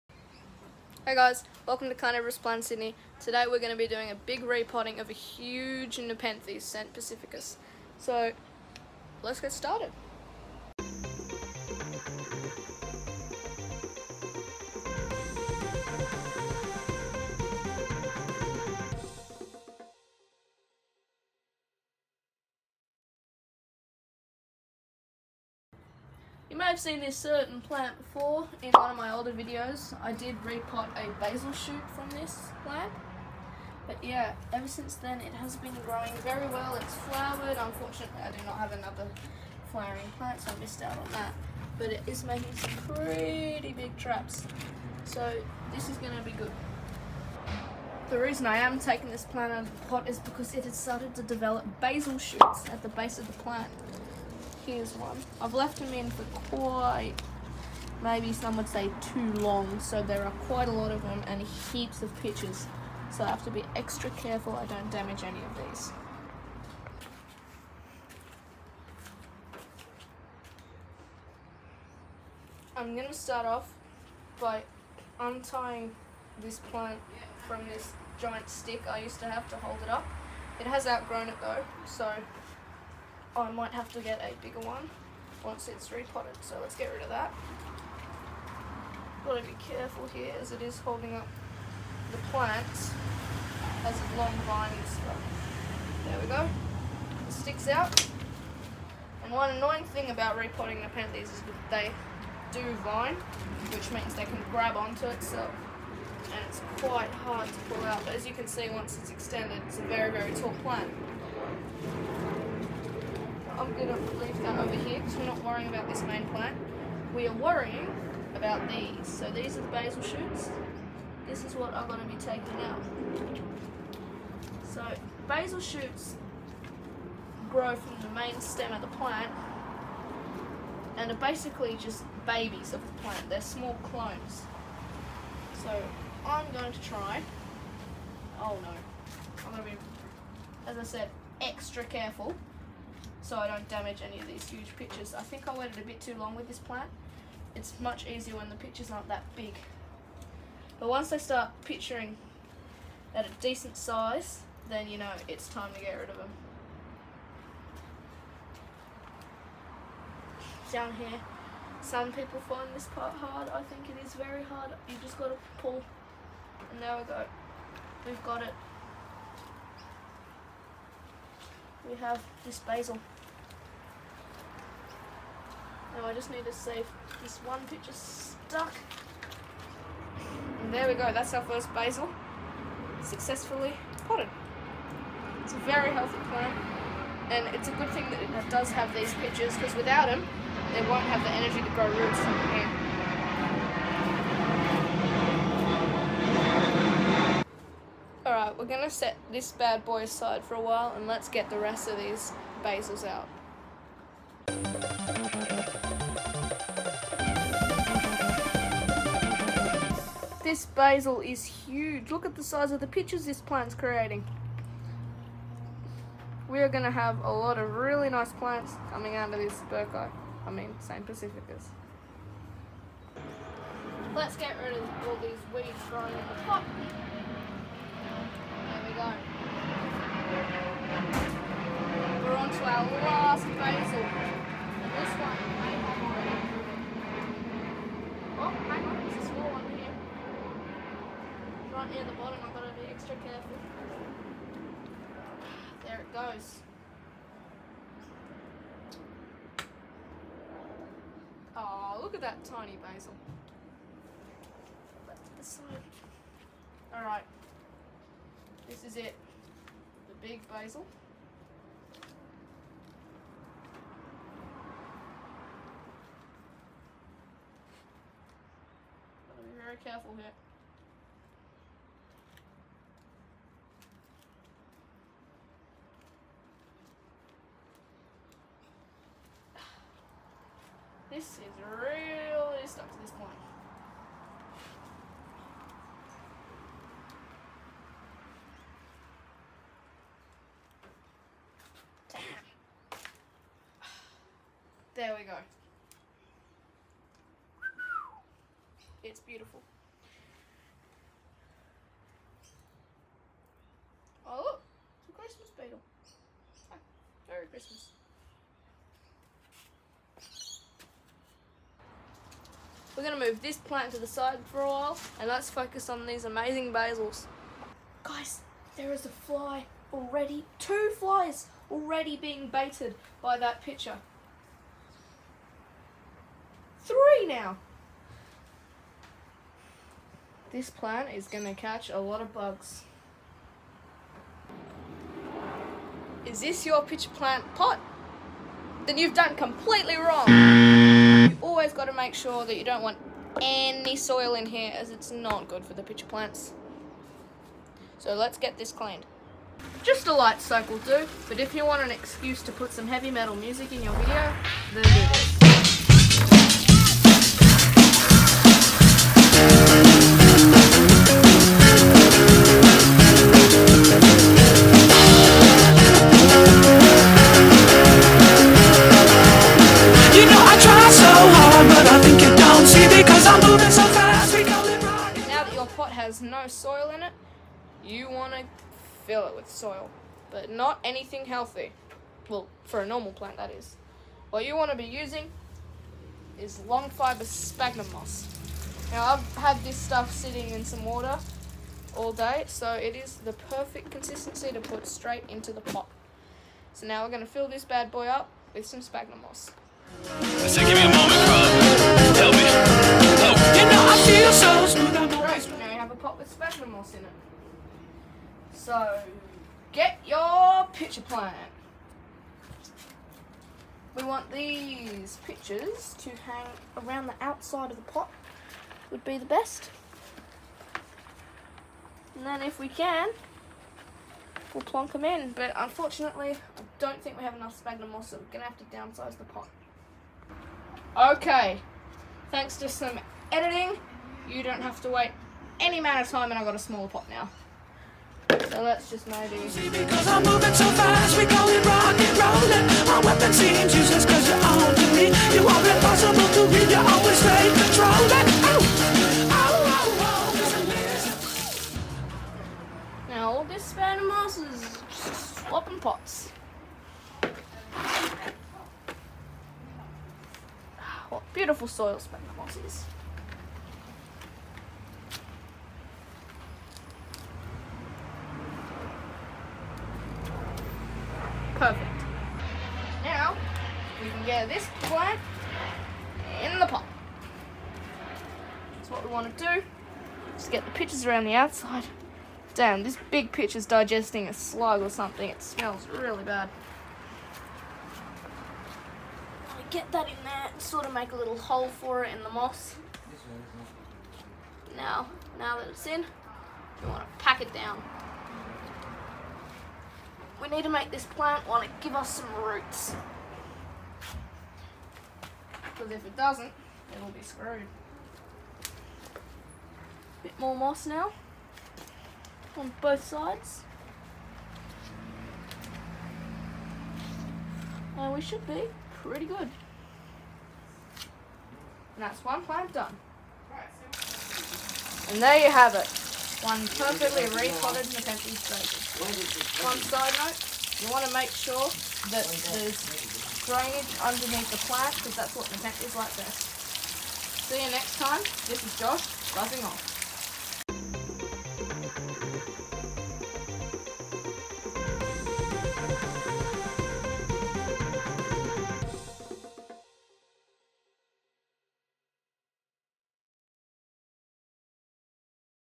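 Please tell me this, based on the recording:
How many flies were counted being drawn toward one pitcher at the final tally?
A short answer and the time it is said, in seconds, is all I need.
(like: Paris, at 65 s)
3, at 326 s.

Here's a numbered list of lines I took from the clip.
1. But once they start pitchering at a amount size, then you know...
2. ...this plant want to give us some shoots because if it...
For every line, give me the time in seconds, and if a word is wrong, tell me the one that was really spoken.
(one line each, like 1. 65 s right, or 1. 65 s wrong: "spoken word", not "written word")
1. 150 s wrong: "decent", not "amount"
2. 500 s wrong: "roots", not "shoots".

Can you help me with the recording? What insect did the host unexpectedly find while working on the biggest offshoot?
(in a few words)
Christmas beetle.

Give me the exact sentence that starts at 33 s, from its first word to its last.
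But yeah, ever since then it has been growing very well.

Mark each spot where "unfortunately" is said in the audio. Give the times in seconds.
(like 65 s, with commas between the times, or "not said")
37 s, 425 s.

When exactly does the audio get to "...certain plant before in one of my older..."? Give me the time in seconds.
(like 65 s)
27 s.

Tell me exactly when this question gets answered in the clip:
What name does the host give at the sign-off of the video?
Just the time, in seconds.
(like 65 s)
538 s.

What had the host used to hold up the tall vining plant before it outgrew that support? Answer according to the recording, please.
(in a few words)
giant stick.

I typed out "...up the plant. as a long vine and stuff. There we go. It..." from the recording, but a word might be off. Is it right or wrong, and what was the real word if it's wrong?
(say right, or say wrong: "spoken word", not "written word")
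right.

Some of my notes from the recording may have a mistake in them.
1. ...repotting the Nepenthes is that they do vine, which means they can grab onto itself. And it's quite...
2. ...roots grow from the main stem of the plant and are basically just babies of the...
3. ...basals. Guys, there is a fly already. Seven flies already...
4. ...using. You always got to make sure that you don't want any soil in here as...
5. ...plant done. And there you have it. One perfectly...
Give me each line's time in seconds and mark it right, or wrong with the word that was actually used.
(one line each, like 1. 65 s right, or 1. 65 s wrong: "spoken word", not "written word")
1. 100 s right
2. 125 s wrong: "shoots", not "roots"
3. 316 s wrong: "Two", not "Seven"
4. 339 s wrong: "wrong", not "using"
5. 522 s right.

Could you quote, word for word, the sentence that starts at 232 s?
We're on to our last basal.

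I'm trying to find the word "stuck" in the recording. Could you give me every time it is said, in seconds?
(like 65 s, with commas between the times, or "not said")
177 s, 282 s.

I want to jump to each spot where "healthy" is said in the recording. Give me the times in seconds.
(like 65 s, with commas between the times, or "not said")
185 s, 381 s.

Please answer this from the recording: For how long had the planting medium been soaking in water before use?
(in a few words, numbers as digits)
all day.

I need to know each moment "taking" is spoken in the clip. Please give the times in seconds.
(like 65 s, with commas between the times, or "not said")
48 s, 122 s.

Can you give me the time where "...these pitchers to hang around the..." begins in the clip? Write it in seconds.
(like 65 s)
414 s.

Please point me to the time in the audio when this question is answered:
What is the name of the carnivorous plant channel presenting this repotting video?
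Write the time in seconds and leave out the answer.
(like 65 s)
1 s.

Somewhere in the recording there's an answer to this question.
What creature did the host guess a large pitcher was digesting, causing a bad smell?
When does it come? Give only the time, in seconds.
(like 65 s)
484 s.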